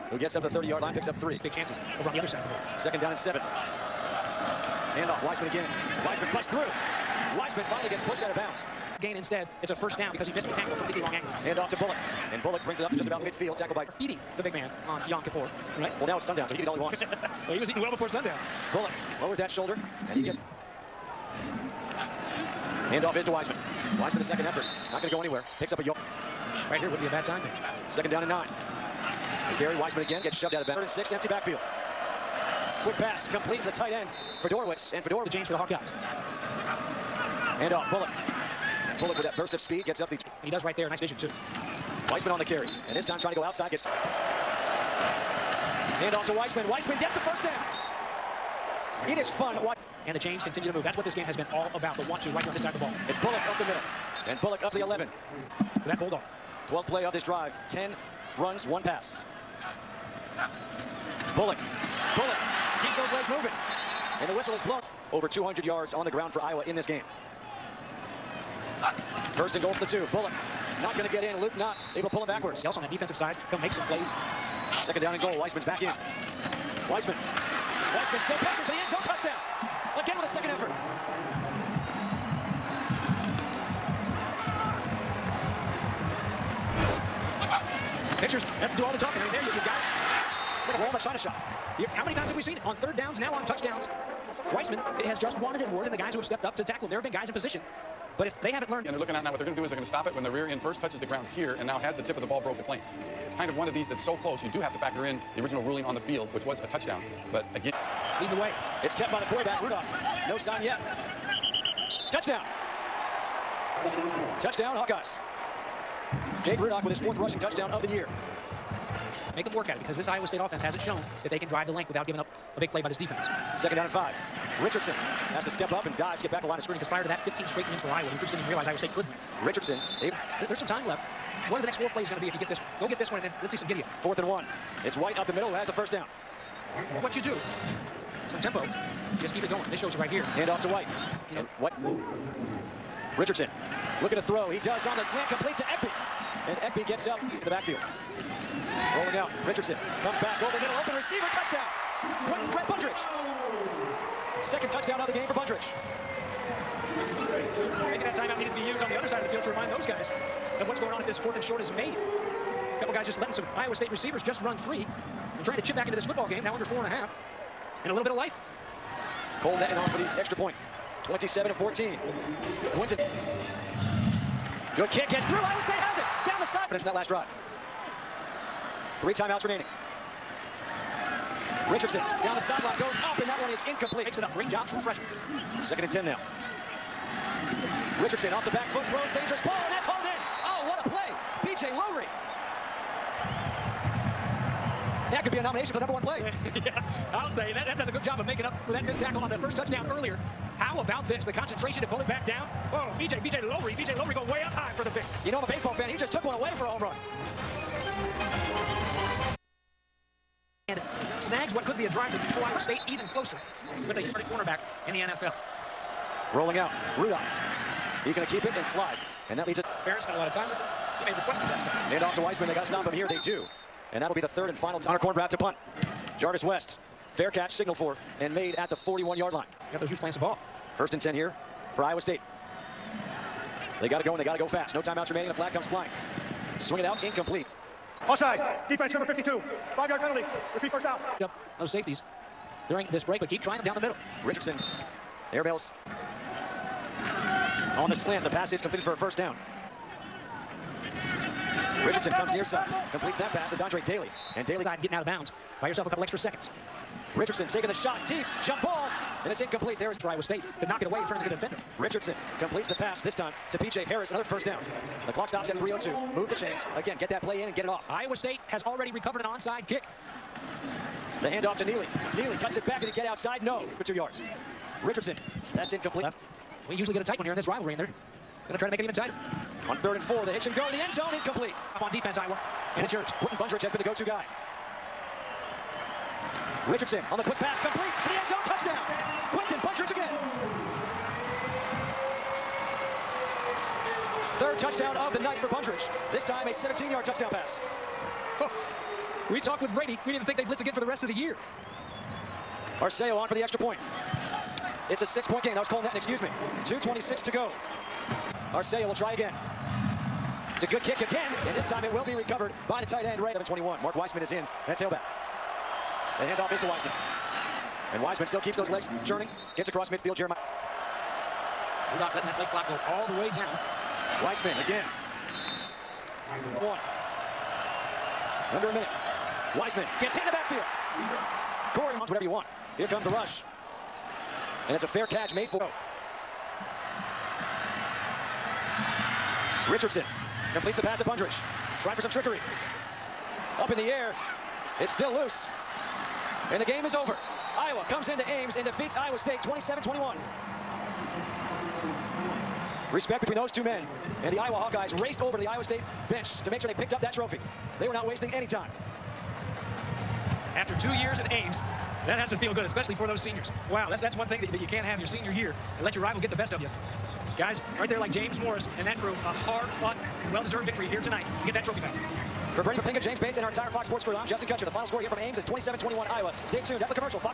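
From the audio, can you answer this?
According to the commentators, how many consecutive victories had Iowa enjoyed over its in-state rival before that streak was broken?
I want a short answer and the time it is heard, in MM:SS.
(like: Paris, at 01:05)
15, at 02:07.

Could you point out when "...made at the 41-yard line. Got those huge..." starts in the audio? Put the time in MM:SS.
03:48.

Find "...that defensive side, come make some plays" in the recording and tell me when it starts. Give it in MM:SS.
01:12.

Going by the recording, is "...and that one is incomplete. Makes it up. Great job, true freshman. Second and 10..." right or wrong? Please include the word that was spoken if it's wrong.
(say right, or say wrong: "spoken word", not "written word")
right.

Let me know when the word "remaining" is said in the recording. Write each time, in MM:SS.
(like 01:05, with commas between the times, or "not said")
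02:59, 03:55.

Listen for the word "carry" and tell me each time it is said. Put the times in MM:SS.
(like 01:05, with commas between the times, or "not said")
00:29, 00:42.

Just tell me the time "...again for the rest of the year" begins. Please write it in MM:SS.
05:00.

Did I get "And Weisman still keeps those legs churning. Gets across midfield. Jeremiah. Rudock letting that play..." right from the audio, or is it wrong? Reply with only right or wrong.
right.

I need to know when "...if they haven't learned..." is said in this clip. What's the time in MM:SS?
01:38.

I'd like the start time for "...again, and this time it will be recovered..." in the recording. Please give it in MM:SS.
05:10.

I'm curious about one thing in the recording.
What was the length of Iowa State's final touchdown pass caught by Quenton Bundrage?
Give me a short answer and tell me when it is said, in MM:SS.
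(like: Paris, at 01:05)
17 yards, at 04:56.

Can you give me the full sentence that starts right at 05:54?
And the Iowa Hawkeyes raced over to the Iowa State bench to make sure they picked up that trophy.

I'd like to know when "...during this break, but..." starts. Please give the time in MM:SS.
04:02.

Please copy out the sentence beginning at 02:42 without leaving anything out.
A couple guys just letting some Iowa State receivers just run free trying to chip back into this football game.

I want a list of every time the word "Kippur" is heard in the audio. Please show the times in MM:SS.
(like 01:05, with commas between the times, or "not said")
00:15.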